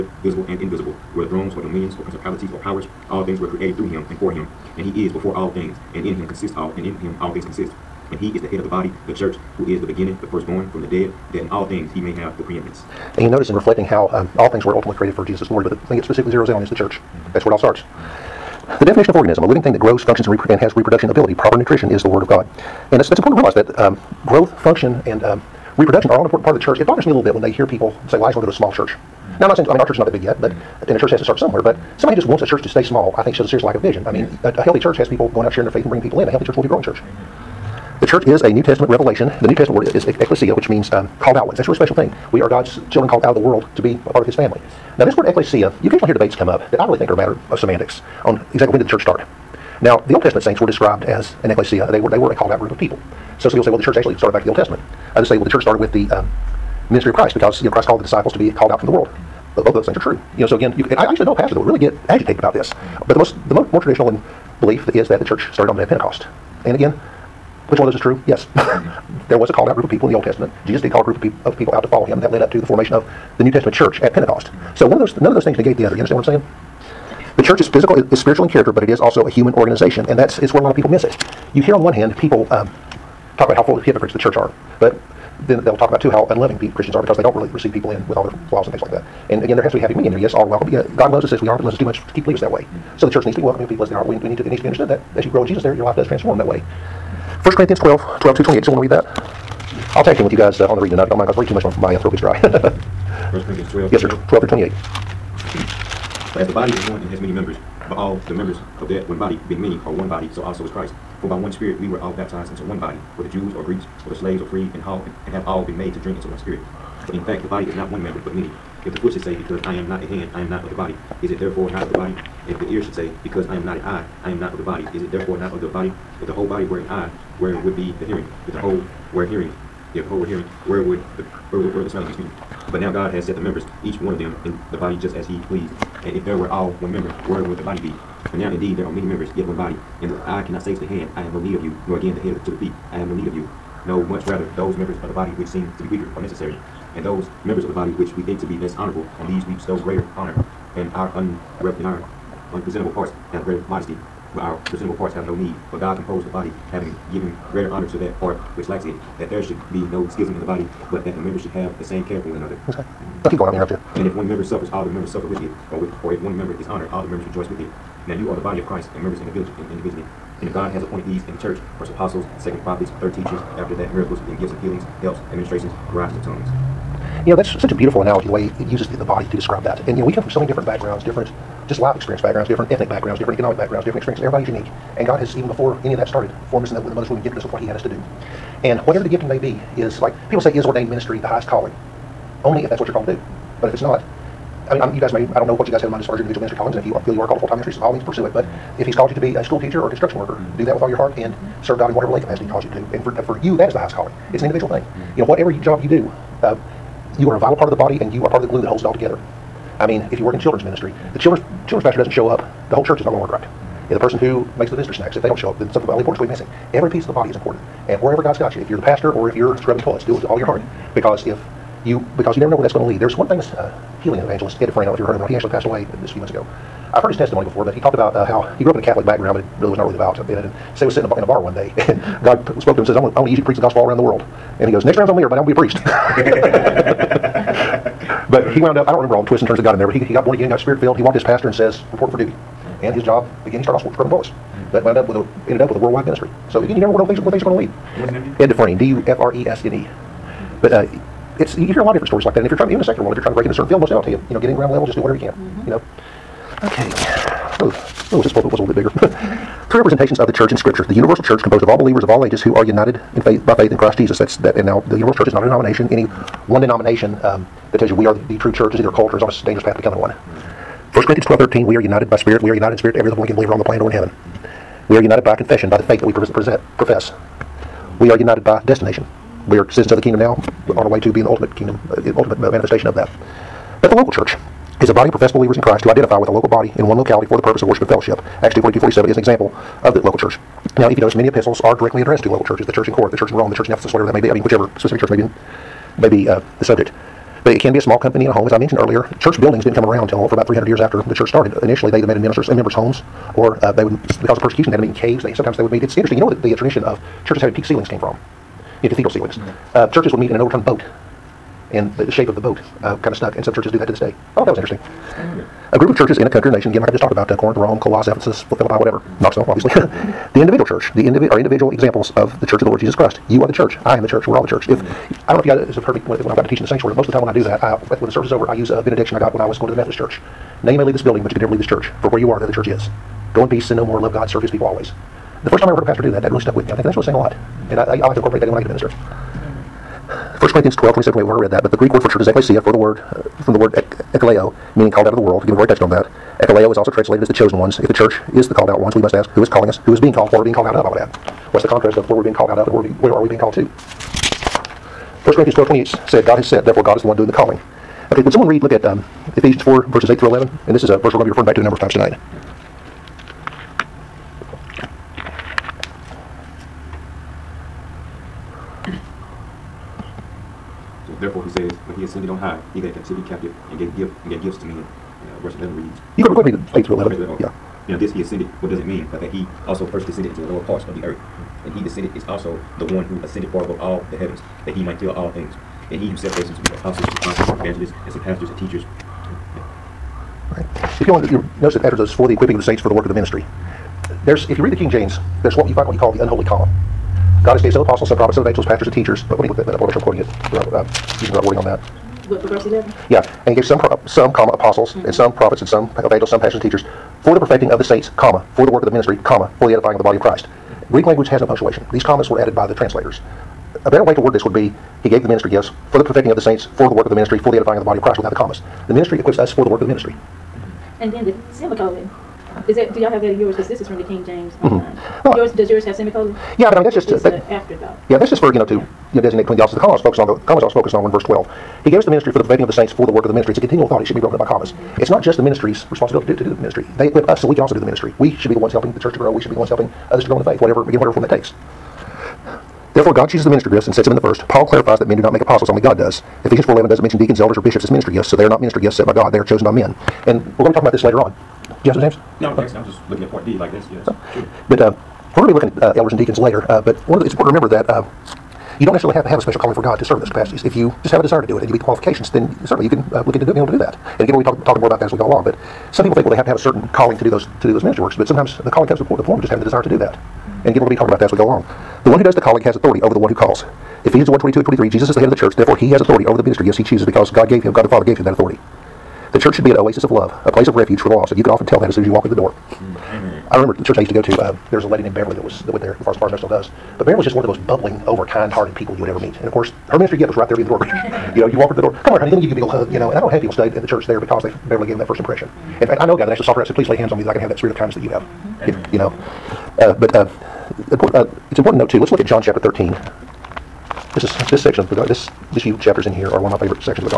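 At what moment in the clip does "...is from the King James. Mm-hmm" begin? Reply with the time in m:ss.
7:03.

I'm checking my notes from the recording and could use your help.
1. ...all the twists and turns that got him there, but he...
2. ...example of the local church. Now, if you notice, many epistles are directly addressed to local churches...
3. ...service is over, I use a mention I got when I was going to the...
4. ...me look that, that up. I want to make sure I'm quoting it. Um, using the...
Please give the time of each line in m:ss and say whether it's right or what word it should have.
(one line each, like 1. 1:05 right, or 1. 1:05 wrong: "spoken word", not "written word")
1. 3:59 right
2. 4:49 right
3. 5:28 wrong: "benediction", not "mention"
4. 6:39 right.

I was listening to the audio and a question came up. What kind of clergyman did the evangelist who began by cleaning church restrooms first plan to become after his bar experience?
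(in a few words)
a priest.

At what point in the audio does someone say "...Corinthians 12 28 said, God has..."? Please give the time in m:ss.
5:55.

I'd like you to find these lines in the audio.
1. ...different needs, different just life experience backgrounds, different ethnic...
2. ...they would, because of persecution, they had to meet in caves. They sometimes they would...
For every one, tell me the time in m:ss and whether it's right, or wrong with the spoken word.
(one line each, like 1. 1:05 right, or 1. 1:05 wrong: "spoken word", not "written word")
1. 3:00 wrong: "backgrounds", not "needs"
2. 5:03 right.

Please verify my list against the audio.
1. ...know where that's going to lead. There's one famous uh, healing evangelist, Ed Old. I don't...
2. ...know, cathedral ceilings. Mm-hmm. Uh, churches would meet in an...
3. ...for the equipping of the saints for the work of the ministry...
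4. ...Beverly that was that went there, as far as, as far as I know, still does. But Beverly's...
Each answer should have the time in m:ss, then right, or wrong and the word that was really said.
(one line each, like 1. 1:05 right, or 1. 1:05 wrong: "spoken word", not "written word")
1. 3:42 wrong: "Dufresne", not "Old"
2. 5:08 right
3. 6:32 right
4. 8:05 right.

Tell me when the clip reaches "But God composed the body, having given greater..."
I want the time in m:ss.
2:35.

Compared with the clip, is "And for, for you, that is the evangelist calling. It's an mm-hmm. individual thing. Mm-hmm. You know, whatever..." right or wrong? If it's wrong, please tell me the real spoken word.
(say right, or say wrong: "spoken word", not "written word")
wrong: "highest", not "evangelist".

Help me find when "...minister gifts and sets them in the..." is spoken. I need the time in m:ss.
7:23.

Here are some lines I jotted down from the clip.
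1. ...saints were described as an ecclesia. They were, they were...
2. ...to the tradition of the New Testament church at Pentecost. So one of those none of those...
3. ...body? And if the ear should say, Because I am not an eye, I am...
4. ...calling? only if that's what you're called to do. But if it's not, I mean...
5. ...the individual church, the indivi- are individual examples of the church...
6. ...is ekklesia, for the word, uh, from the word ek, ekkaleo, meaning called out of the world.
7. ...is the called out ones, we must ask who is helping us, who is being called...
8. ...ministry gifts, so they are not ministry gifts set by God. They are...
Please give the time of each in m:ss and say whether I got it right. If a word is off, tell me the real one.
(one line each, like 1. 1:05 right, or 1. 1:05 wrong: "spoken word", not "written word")
1. 0:50 right
2. 1:12 wrong: "formation", not "tradition"
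3. 2:01 right
4. 3:11 right
5. 5:19 right
6. 5:42 right
7. 5:48 wrong: "calling", not "helping"
8. 7:27 right.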